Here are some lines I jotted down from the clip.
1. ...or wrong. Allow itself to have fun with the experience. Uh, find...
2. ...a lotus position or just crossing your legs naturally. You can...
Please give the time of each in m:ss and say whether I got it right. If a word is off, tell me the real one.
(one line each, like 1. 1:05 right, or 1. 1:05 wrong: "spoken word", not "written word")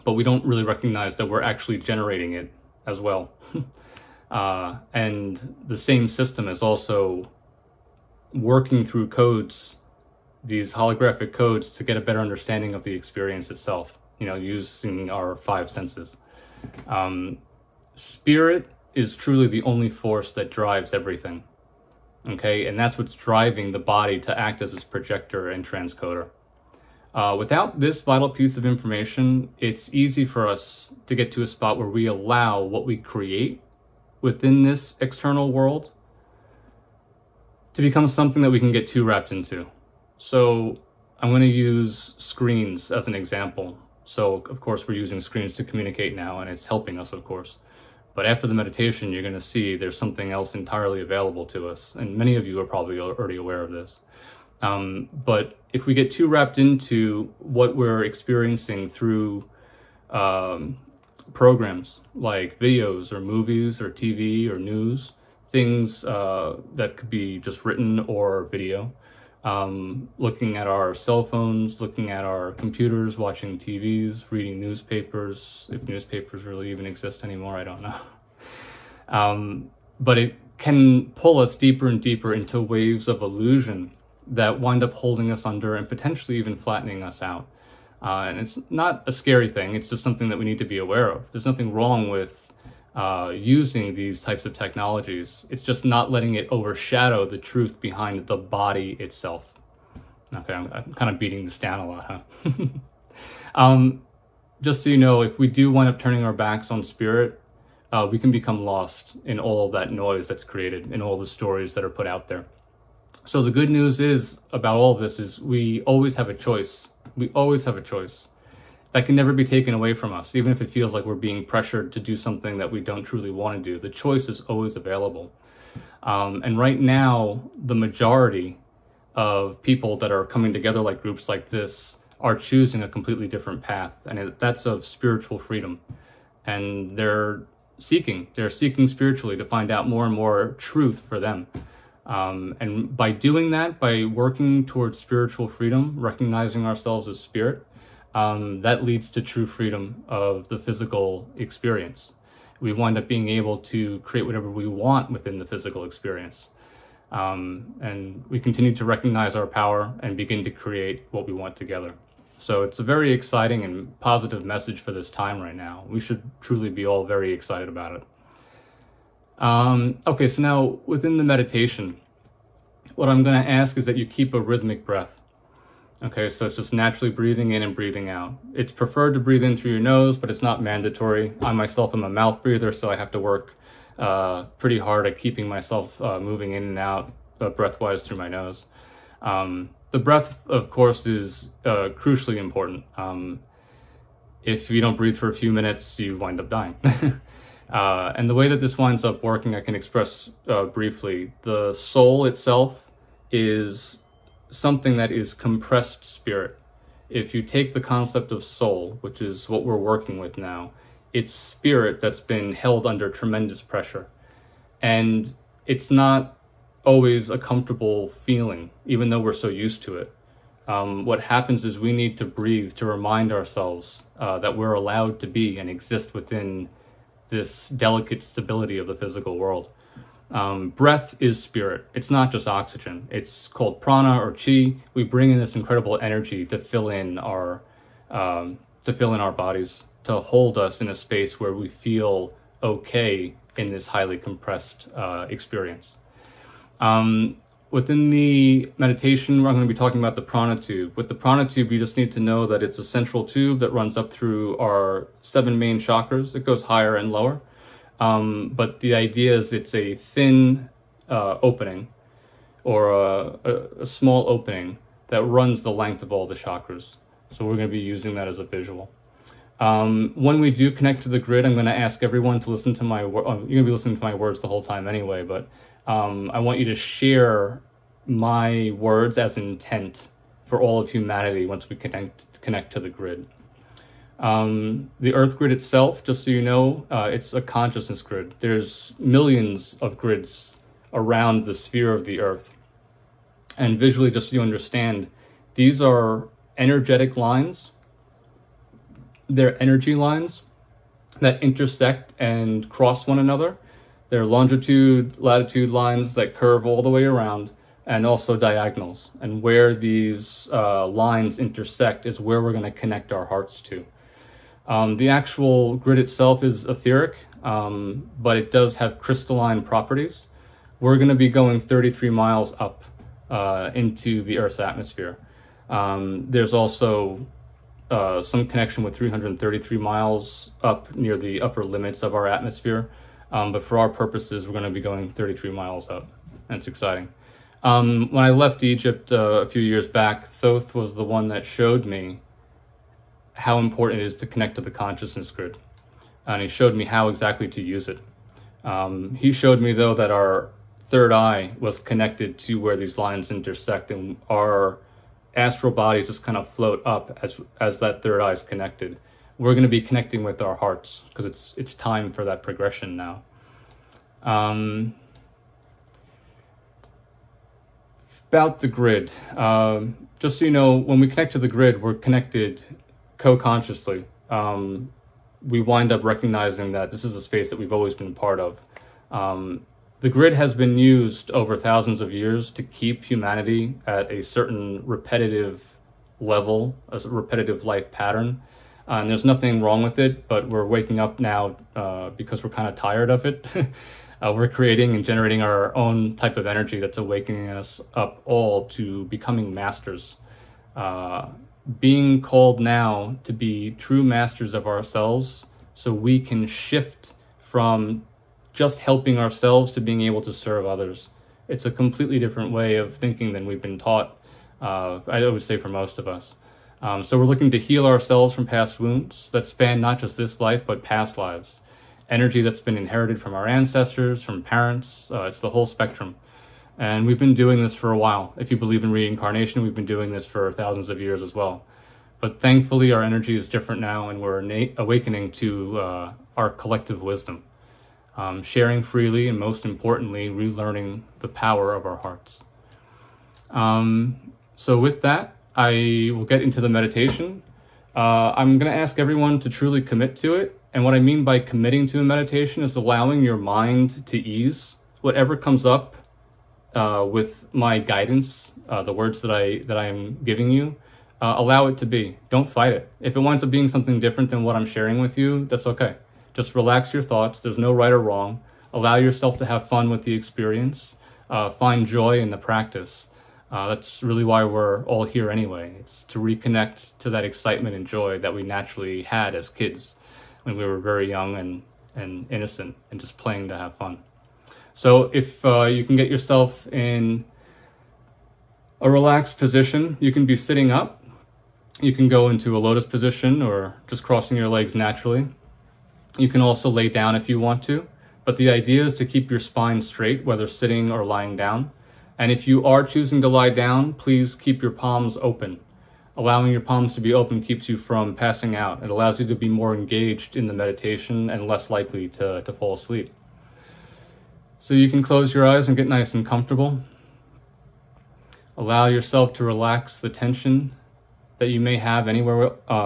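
1. 7:47 wrong: "yourself", not "itself"
2. 8:12 right.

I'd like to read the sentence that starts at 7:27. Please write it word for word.
Uh, I'm going to ask everyone to truly commit to it.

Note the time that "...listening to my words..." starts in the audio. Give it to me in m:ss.
4:33.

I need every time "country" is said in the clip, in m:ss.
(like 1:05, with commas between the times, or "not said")
not said.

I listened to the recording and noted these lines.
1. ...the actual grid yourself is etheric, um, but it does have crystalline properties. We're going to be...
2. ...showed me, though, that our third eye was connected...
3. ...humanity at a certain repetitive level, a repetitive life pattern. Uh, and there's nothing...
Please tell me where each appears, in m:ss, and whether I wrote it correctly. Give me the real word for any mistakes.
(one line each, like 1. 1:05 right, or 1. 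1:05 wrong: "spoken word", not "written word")
1. 5:14 wrong: "itself", not "yourself"
2. 5:49 right
3. 6:23 right.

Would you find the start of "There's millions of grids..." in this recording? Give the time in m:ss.
4:48.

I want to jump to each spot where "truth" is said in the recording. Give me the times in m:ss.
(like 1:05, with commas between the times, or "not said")
1:37, 2:20.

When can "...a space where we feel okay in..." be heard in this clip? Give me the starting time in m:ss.
4:00.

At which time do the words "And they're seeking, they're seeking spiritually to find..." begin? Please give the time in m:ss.
2:16.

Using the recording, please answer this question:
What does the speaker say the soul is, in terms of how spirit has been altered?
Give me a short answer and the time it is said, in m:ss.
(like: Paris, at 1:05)
compressed spirit, at 3:25.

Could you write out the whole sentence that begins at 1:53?
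So the good news is about all of this is we always have a choice.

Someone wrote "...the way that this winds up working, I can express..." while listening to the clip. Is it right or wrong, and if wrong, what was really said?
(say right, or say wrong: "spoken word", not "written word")
right.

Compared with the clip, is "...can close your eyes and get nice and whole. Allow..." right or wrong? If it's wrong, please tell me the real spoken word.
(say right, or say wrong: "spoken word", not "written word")
wrong: "comfortable", not "whole".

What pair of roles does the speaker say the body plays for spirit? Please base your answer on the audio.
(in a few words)
projector and transcoder.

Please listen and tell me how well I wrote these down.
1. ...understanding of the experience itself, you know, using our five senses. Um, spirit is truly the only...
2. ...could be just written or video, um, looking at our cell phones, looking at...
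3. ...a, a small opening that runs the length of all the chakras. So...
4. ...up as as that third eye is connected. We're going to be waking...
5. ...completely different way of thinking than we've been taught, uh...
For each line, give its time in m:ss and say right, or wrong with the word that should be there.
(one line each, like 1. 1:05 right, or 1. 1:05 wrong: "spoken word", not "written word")
1. 0:12 right
2. 1:06 right
3. 4:23 right
4. 5:56 wrong: "connecting", not "waking"
5. 6:51 right.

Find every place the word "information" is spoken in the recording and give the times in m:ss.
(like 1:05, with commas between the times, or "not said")
0:28.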